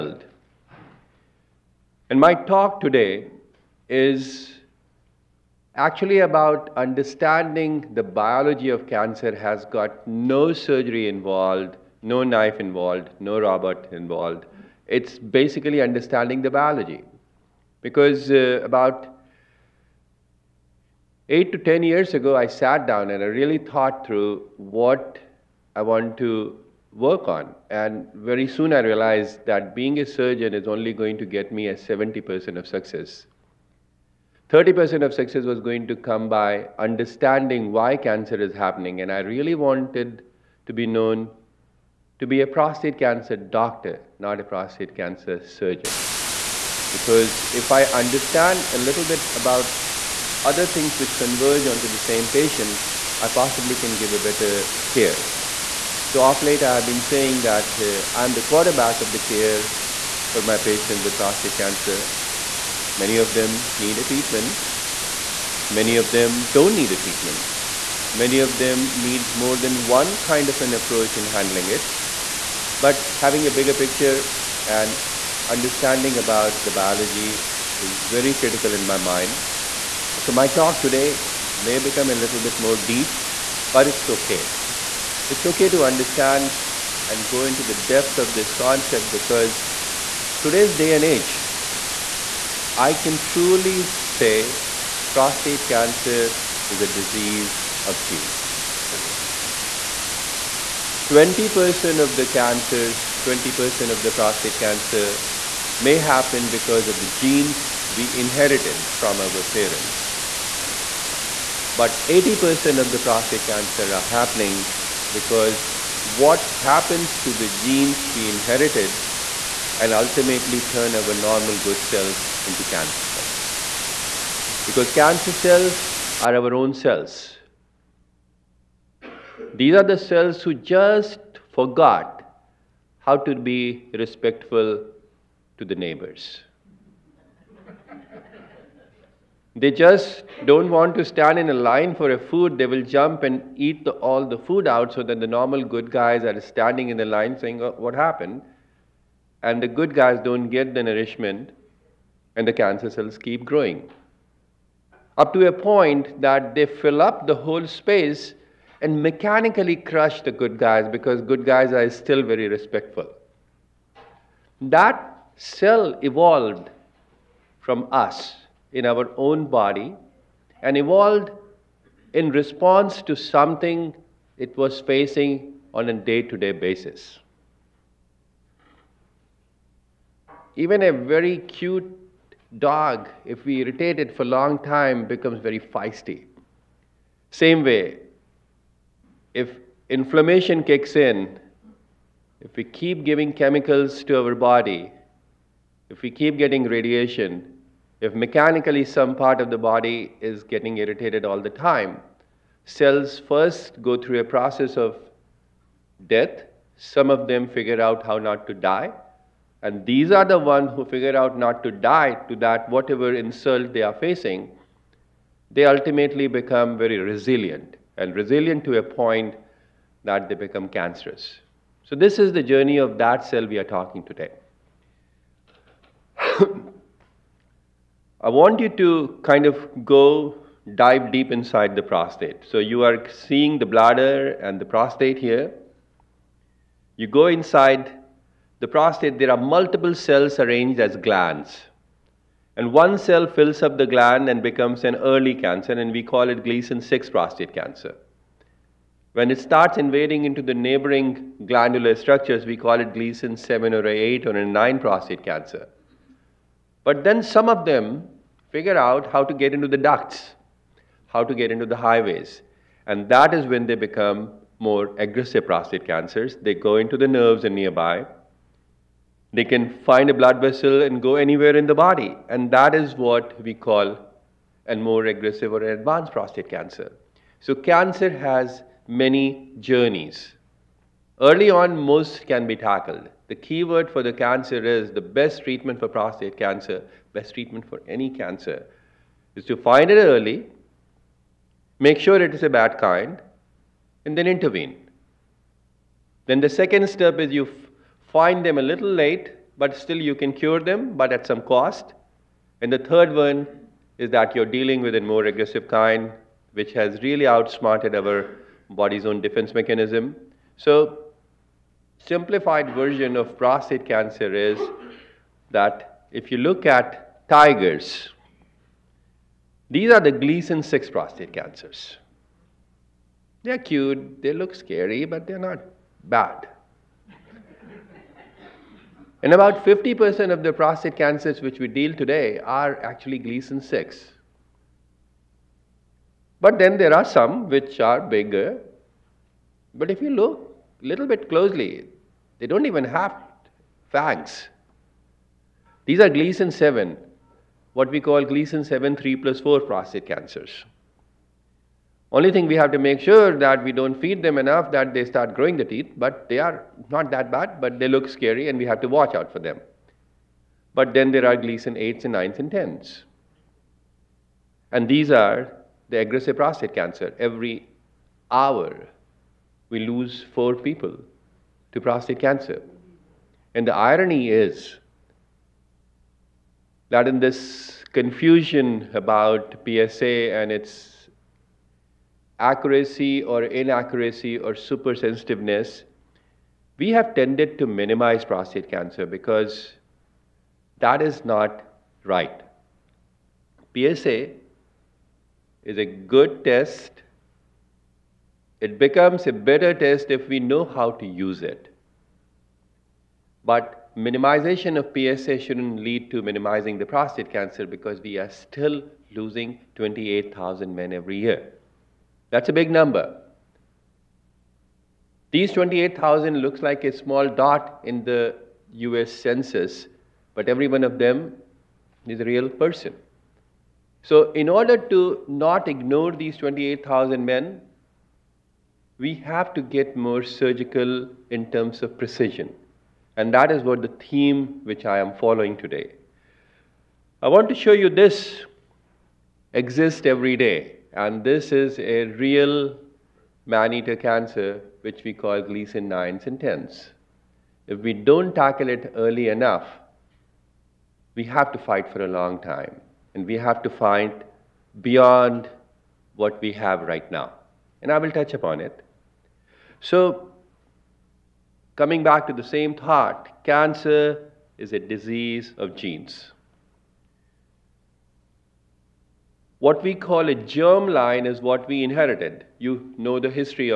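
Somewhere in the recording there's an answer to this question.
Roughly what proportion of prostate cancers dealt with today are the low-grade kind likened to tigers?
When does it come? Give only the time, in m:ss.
5:29.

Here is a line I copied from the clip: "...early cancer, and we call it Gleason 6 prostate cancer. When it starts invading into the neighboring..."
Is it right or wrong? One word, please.
right.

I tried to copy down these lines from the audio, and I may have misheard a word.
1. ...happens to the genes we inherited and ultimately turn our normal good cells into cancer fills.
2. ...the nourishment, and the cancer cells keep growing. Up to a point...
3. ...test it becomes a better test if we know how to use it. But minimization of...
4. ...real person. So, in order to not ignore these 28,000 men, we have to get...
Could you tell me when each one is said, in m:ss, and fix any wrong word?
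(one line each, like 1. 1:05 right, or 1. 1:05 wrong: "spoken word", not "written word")
1. 1:56 wrong: "cells", not "fills"
2. 2:30 right
3. 6:36 right
4. 7:02 right.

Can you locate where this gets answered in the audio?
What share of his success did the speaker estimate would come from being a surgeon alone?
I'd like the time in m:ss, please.
0:31.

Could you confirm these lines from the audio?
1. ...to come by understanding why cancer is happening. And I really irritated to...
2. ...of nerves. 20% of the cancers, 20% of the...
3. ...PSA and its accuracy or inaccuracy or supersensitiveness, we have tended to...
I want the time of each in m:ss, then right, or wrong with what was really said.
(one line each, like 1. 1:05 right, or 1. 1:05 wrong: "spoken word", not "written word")
1. 0:35 wrong: "wanted", not "irritated"
2. 1:37 wrong: "genes", not "nerves"
3. 6:19 right.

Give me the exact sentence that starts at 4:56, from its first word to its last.
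Then the second step is you find them a little late, but still you can cure them, but at some cost.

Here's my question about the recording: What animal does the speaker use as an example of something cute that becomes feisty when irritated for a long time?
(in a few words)
dog.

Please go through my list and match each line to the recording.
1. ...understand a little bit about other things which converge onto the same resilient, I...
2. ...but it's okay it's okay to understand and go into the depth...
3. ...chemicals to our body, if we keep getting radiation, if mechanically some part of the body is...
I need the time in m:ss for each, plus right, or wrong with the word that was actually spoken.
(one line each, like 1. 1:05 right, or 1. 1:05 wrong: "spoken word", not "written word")
1. 0:47 wrong: "patient", not "resilient"
2. 1:23 right
3. 3:13 right.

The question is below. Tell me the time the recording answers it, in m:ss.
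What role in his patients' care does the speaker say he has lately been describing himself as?
0:58.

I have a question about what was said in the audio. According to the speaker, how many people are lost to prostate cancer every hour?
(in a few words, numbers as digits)
4.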